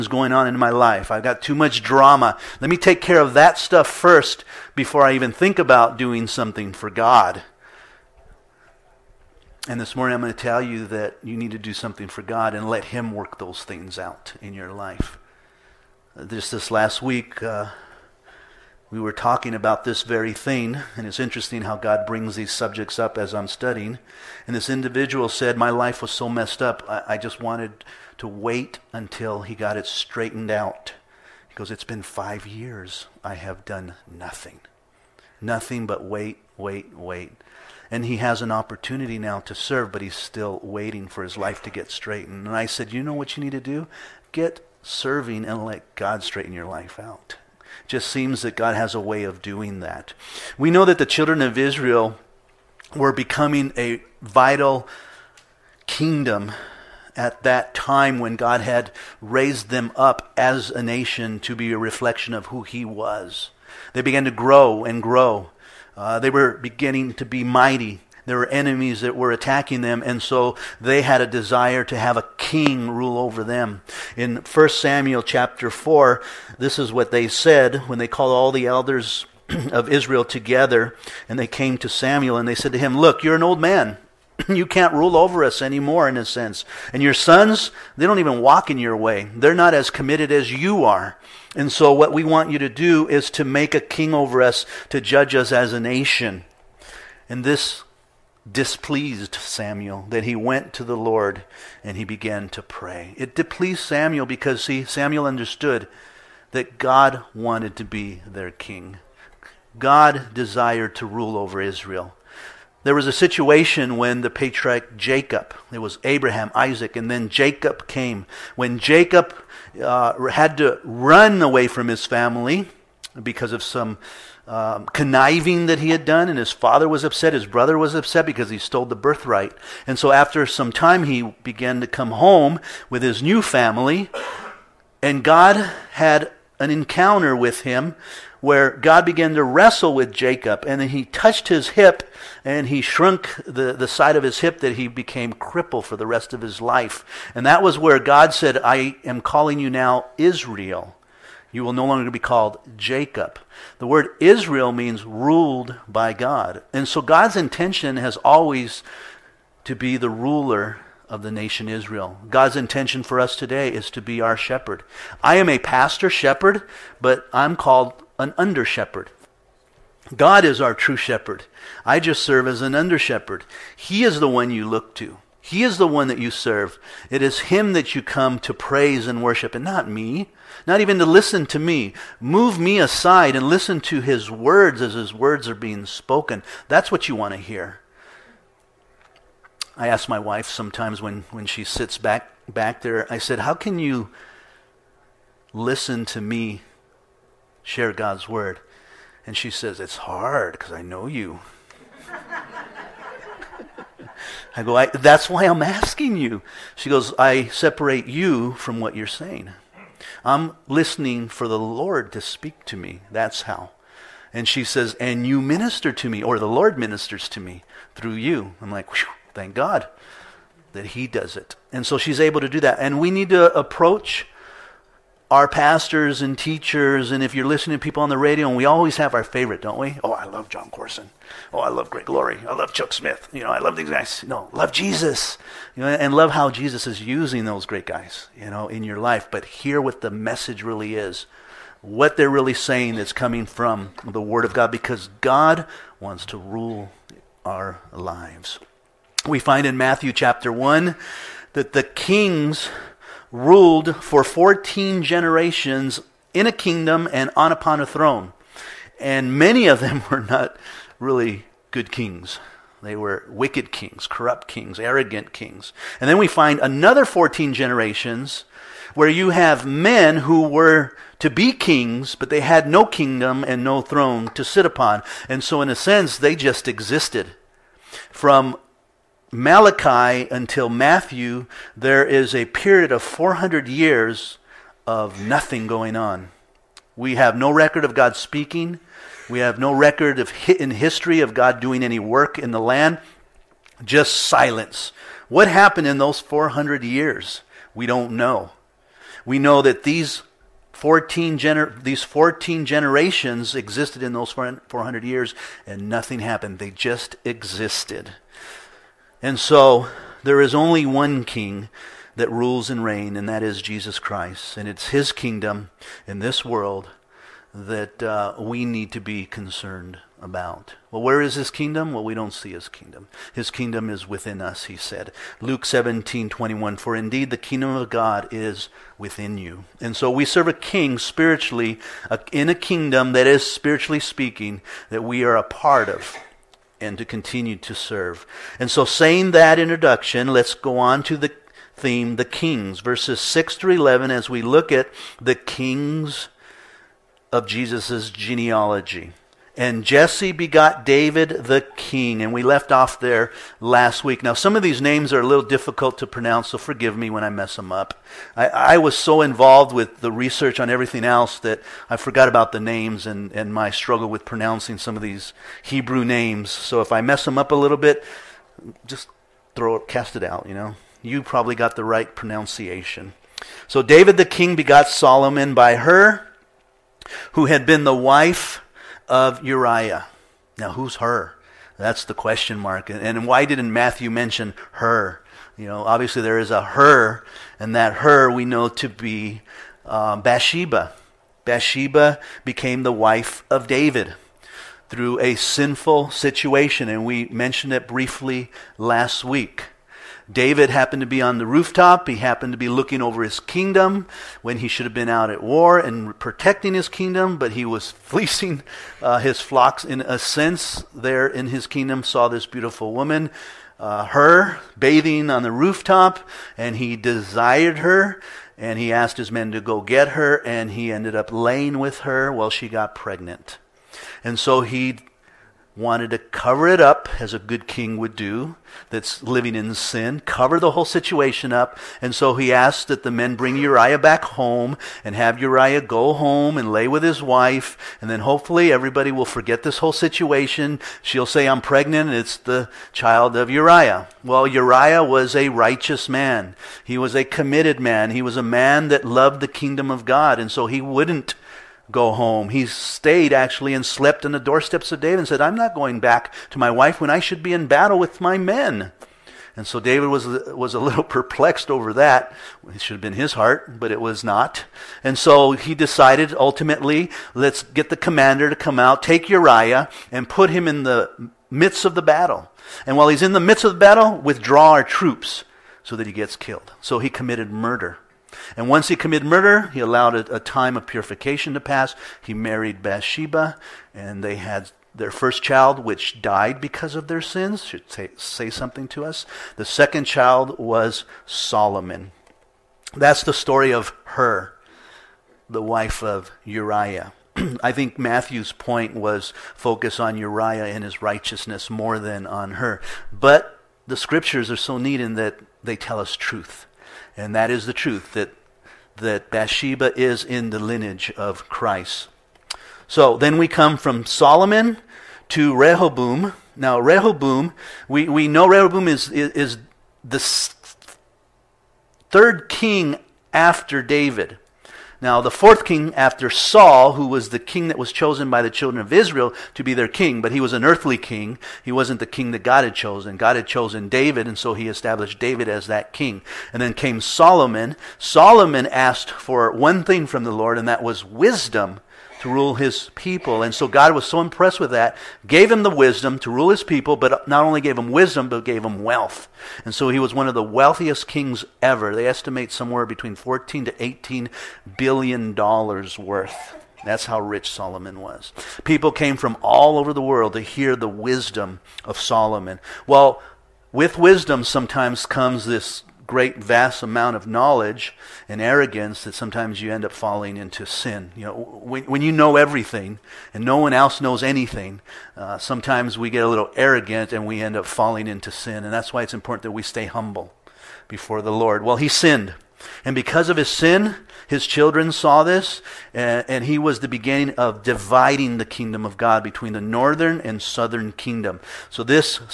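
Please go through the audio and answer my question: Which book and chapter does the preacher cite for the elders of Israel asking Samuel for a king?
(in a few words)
1 Samuel 4.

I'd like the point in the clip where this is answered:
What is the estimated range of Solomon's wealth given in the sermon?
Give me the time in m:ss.
9:13.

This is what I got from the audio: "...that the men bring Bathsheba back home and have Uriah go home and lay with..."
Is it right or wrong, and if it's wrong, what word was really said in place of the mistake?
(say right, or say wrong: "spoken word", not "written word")
wrong: "Uriah", not "Bathsheba".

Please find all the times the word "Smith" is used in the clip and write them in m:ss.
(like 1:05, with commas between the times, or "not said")
3:52.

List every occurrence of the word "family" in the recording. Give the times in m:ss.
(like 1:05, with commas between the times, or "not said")
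2:02, 2:13.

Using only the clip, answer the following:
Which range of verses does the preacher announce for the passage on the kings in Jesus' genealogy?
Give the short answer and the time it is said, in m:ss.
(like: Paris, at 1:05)
6 through 11, at 5:42.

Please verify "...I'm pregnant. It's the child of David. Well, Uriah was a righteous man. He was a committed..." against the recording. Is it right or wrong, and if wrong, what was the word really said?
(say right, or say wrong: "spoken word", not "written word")
wrong: "Uriah", not "David".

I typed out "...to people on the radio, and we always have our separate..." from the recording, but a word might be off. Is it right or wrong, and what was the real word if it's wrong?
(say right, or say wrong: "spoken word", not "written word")
wrong: "favorite", not "separate".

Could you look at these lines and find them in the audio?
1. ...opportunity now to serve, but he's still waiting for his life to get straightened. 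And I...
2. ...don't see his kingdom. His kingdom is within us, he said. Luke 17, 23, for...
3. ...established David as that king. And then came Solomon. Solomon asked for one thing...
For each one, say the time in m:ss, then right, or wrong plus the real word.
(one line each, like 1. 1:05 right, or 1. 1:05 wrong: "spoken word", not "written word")
1. 0:38 right
2. 5:22 wrong: "21", not "23"
3. 8:54 right.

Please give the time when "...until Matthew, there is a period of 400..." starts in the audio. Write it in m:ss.
4:40.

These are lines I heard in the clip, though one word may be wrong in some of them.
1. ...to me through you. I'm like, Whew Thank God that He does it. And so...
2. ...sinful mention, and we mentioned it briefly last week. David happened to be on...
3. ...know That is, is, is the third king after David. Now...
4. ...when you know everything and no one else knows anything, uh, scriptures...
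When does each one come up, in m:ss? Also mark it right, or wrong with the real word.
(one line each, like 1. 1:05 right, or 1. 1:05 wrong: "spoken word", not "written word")
1. 3:37 right
2. 6:35 wrong: "situation", not "mention"
3. 8:38 wrong: "Rehoboam", not "That"
4. 9:31 wrong: "sometimes", not "scriptures".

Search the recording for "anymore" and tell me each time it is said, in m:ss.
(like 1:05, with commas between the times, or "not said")
1:25.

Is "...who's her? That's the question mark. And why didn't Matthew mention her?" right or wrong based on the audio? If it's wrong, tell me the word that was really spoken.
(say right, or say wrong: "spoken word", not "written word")
right.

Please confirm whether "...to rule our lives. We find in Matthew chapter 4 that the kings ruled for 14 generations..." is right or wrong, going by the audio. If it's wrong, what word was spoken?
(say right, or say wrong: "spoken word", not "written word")
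wrong: "1", not "4".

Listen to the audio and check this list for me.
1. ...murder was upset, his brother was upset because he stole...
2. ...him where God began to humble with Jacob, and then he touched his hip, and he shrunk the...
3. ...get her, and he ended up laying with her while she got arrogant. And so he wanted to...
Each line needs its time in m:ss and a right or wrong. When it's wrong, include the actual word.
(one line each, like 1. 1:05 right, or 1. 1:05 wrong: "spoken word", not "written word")
1. 2:06 wrong: "father", not "murder"
2. 2:17 wrong: "wrestle", not "humble"
3. 6:59 wrong: "pregnant", not "arrogant".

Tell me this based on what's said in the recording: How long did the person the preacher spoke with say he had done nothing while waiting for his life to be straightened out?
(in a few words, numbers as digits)
5 years.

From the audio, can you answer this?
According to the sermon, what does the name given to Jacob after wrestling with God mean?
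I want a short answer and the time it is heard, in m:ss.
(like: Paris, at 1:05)
ruled by God, at 2:35.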